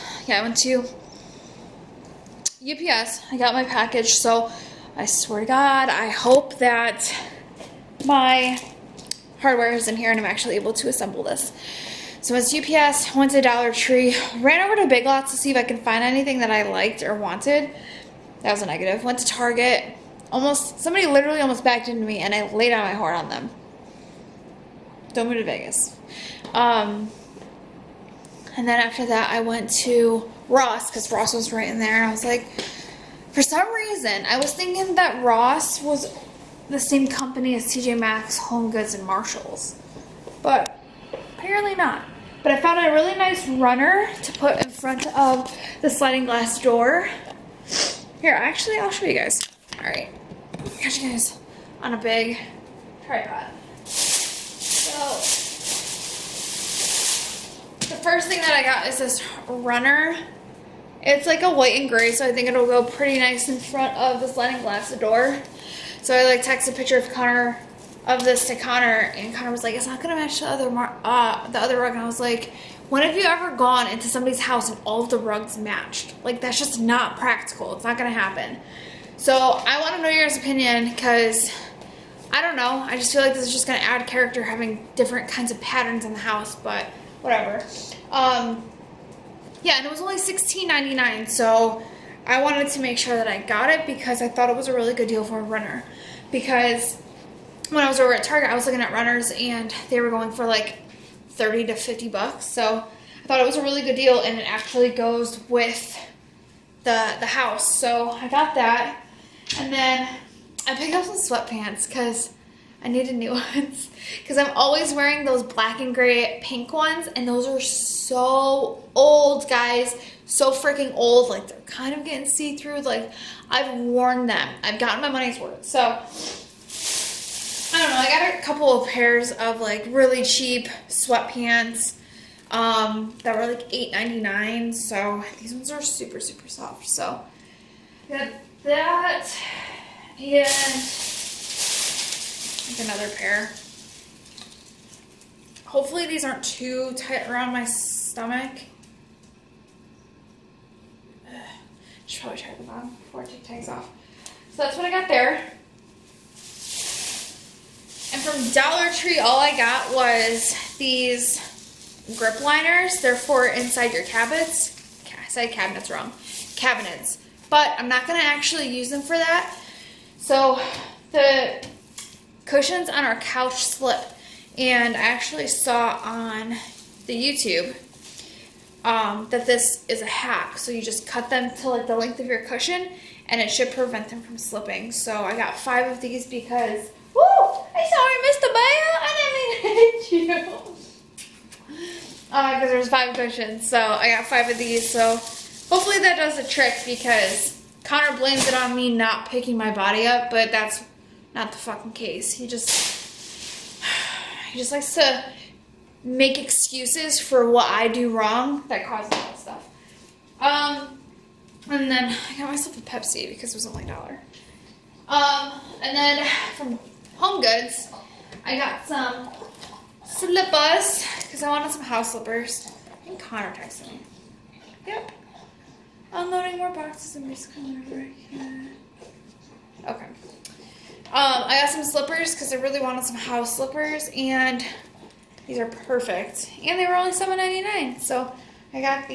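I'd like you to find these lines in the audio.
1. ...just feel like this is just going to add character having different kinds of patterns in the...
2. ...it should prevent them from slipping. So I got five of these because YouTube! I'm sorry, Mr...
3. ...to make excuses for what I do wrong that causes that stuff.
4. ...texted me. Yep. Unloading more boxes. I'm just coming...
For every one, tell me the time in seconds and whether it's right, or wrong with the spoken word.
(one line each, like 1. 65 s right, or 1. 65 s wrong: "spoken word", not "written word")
1. 82 s right
2. 183 s wrong: "Woo", not "YouTube"
3. 204 s right
4. 223 s right.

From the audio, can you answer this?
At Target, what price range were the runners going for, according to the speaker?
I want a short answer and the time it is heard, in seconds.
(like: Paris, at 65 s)
$30 to $50, at 101 s.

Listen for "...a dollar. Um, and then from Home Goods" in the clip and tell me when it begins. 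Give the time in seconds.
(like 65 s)
213 s.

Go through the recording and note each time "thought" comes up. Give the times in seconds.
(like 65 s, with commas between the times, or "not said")
94 s, 103 s.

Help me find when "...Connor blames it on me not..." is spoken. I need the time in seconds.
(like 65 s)
197 s.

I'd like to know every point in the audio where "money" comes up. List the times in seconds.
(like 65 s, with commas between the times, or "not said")
125 s.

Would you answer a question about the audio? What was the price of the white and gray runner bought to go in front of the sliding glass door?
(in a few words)
$16.99.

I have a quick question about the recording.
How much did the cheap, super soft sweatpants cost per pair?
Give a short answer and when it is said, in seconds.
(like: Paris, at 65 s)
$8.99, at 133 s.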